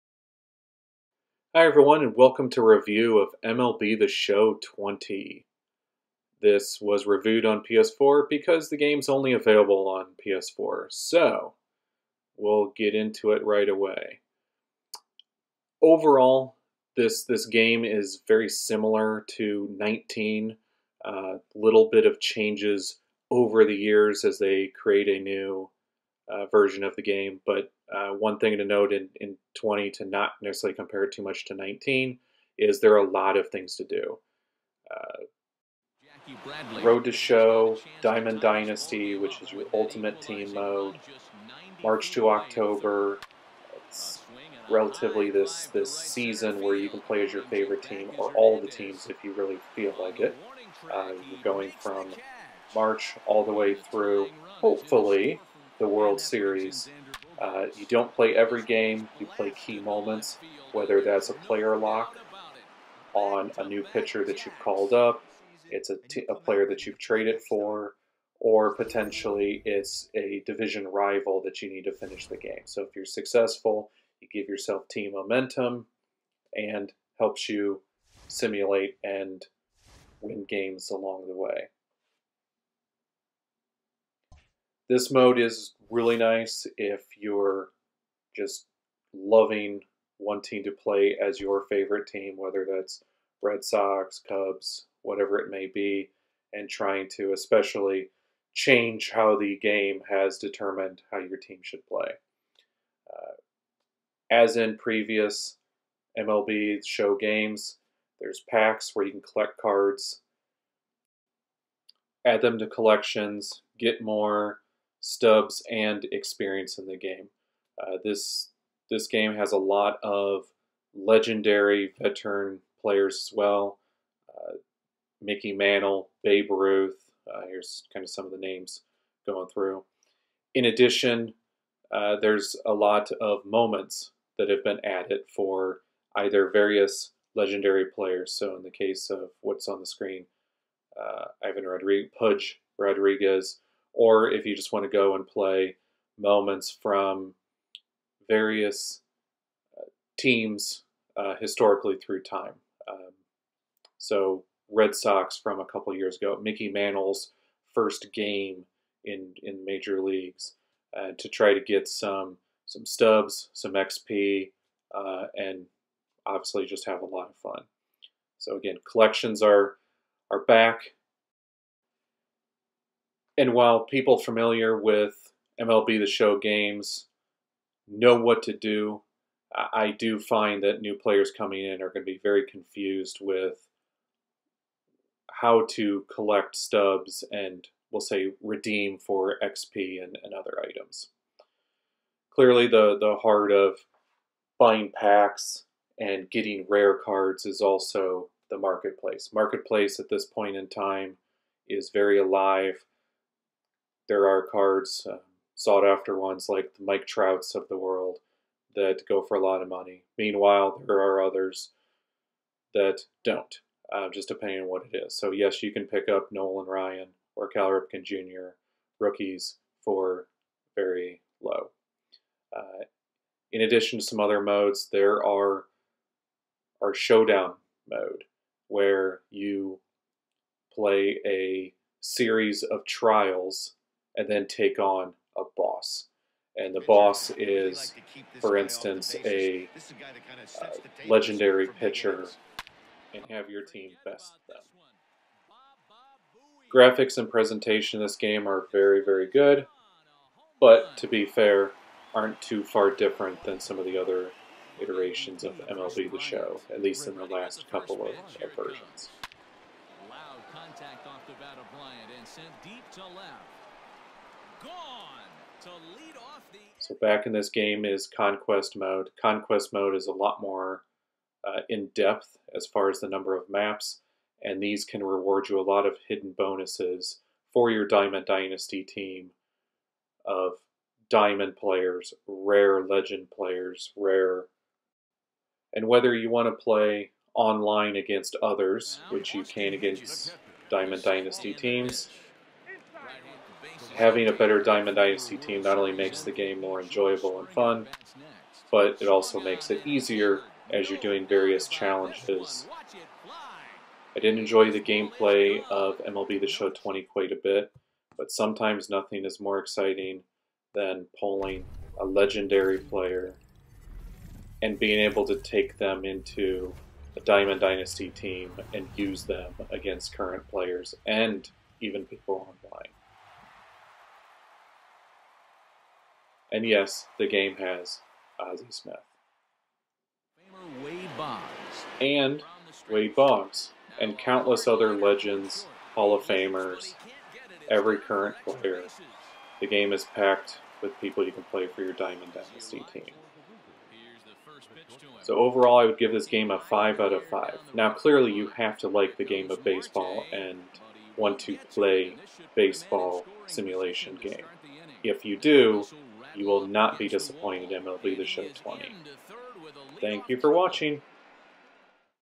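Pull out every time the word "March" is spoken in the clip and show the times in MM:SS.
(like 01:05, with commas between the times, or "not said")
00:41, 00:52.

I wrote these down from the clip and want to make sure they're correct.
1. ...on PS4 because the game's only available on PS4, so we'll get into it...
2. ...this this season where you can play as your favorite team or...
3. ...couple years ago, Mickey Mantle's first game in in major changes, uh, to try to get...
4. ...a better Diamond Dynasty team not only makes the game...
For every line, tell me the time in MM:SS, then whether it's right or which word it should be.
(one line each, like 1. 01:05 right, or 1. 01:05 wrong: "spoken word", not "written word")
1. 00:07 right
2. 00:45 right
3. 02:35 wrong: "leagues", not "changes"
4. 04:54 right.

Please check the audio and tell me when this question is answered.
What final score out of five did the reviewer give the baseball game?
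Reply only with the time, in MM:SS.
05:46.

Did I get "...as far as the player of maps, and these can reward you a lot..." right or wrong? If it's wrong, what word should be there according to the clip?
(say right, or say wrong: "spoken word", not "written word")
wrong: "number", not "player".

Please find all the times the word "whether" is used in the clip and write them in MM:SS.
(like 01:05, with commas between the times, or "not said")
01:00, 01:32, 04:45.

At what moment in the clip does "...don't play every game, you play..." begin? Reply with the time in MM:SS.
00:57.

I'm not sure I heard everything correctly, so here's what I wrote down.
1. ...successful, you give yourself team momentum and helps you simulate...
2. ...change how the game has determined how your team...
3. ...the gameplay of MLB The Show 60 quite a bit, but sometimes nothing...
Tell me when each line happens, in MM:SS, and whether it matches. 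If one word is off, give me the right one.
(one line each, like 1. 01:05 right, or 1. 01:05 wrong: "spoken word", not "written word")
1. 01:13 right
2. 01:38 right
3. 05:04 wrong: "20", not "60".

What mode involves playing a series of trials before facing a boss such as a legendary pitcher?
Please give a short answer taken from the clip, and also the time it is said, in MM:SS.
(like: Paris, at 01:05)
Showdown mode, at 03:46.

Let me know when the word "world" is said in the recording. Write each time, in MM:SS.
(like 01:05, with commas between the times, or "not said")
00:55, 03:27.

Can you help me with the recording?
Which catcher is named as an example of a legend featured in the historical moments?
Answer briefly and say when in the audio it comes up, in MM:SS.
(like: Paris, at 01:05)
Ivan Rodriguez, at 02:21.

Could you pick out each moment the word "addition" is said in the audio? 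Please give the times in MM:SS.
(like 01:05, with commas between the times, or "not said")
02:10, 03:43.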